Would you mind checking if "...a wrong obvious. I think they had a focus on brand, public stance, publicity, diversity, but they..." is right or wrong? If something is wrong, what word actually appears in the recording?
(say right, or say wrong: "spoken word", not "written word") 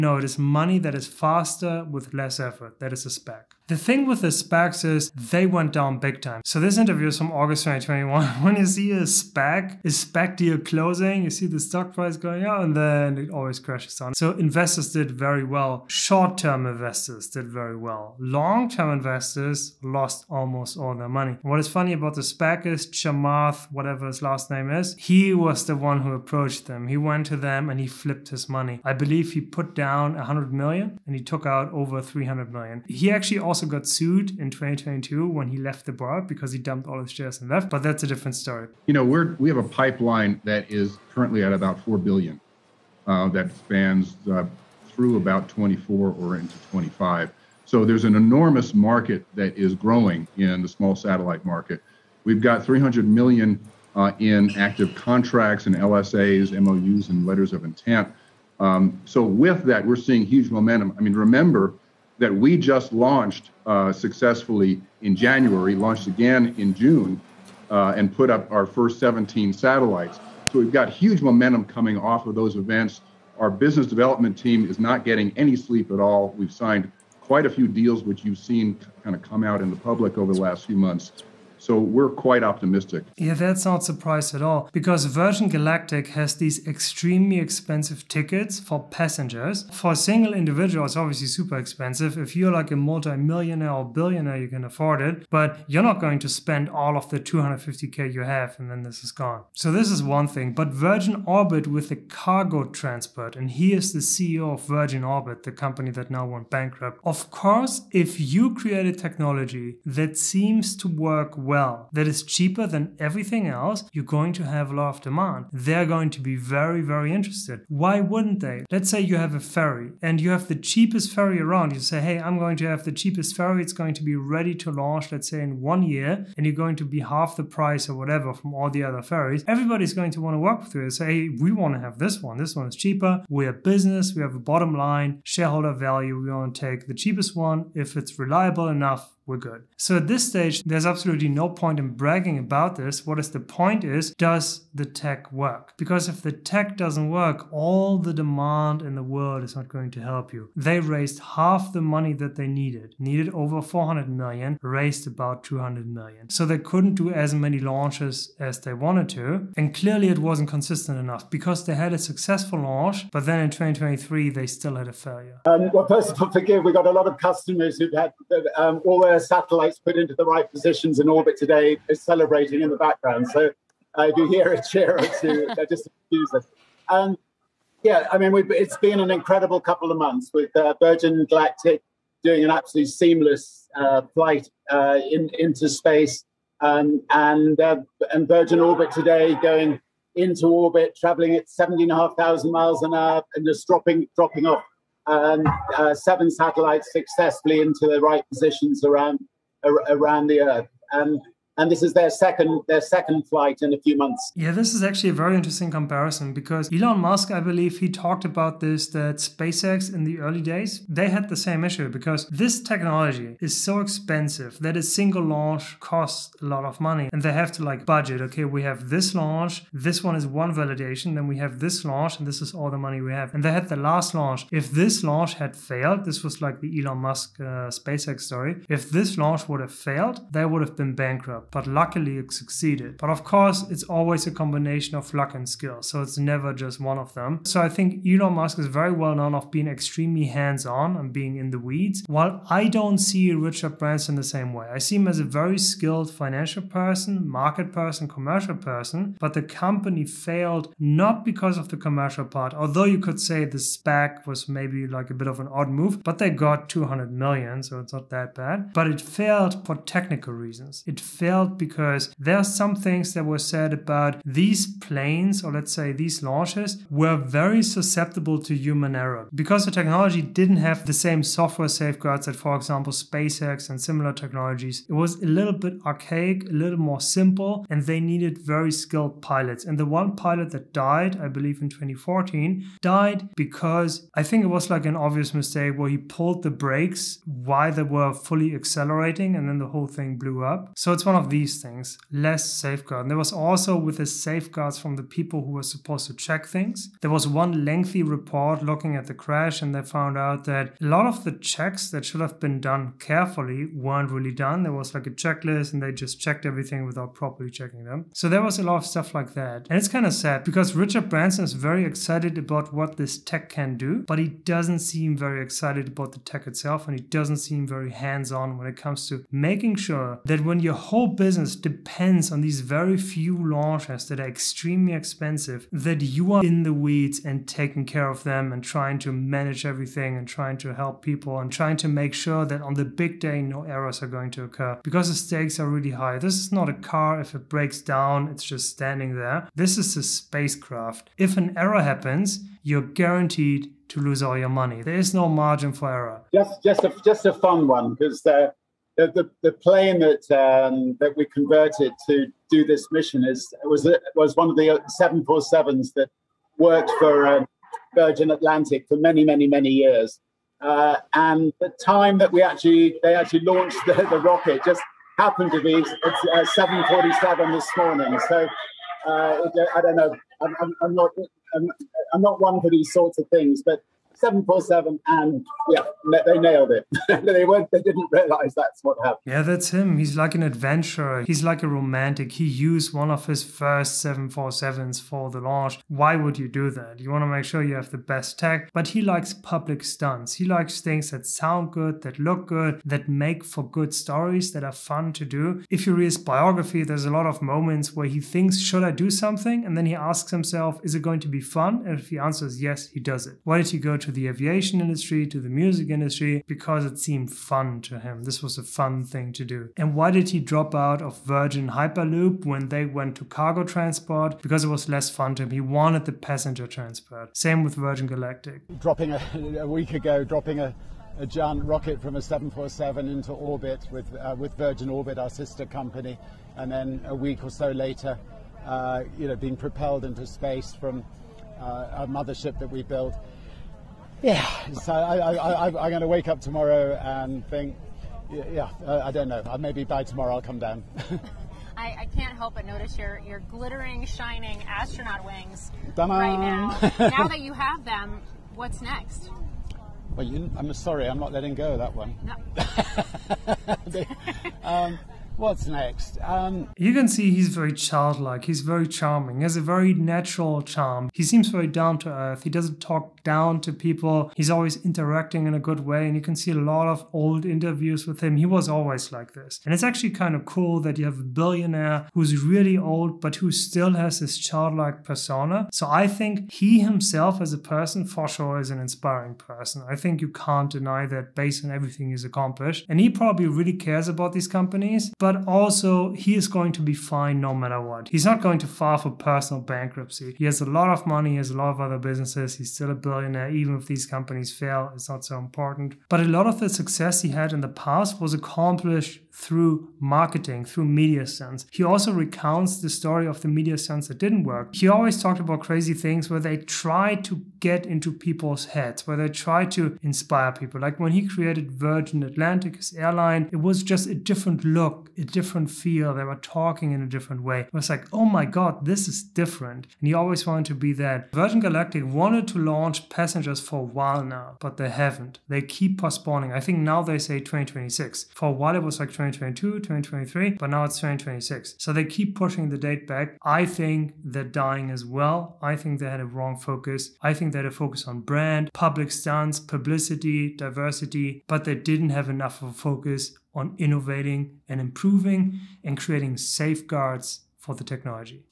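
wrong: "focus", not "obvious".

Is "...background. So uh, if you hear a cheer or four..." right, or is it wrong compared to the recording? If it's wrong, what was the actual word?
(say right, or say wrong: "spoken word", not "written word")
wrong: "two", not "four".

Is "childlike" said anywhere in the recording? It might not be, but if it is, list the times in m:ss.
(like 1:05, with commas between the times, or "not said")
7:37, 7:54.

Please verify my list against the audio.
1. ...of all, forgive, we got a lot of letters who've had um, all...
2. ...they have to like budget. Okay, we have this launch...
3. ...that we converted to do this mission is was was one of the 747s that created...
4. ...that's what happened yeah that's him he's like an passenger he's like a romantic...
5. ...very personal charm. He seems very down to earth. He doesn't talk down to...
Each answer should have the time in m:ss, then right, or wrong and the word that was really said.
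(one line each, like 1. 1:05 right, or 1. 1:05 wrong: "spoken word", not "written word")
1. 2:46 wrong: "customers", not "letters"
2. 3:37 right
3. 5:50 wrong: "worked", not "created"
4. 6:18 wrong: "adventurer", not "passenger"
5. 7:39 wrong: "natural", not "personal".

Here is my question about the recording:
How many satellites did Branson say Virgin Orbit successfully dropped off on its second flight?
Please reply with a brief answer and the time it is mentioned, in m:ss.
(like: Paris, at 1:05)
7, at 3:15.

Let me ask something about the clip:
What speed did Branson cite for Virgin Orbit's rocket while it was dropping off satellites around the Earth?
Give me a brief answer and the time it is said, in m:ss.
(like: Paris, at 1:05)
17,500 miles an hour, at 3:11.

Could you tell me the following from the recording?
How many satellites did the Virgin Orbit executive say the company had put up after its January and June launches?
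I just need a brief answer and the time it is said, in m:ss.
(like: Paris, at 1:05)
17, at 1:08.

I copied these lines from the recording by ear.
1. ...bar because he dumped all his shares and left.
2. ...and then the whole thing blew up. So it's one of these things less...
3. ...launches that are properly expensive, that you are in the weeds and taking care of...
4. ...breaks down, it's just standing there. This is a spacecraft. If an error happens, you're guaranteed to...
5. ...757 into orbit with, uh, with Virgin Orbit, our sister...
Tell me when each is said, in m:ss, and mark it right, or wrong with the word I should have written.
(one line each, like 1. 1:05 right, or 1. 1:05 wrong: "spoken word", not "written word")
1. 0:35 right
2. 4:49 right
3. 5:23 wrong: "extremely", not "properly"
4. 5:37 right
5. 7:02 wrong: "747", not "757".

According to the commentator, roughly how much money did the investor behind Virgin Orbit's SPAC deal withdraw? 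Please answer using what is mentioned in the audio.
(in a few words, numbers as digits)
over 300 million.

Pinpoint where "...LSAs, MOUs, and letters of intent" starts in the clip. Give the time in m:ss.
0:55.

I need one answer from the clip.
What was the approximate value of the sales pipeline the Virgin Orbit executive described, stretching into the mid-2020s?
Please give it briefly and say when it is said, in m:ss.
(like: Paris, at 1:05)
4 billion, at 0:41.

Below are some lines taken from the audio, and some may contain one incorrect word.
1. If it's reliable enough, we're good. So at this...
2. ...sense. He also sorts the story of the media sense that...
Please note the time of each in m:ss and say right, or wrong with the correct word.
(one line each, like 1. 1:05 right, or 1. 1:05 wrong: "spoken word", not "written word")
1. 2:17 right
2. 8:21 wrong: "recounts", not "sorts".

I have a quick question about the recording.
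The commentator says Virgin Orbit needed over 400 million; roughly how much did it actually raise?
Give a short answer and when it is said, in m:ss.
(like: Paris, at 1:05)
200 million, at 2:35.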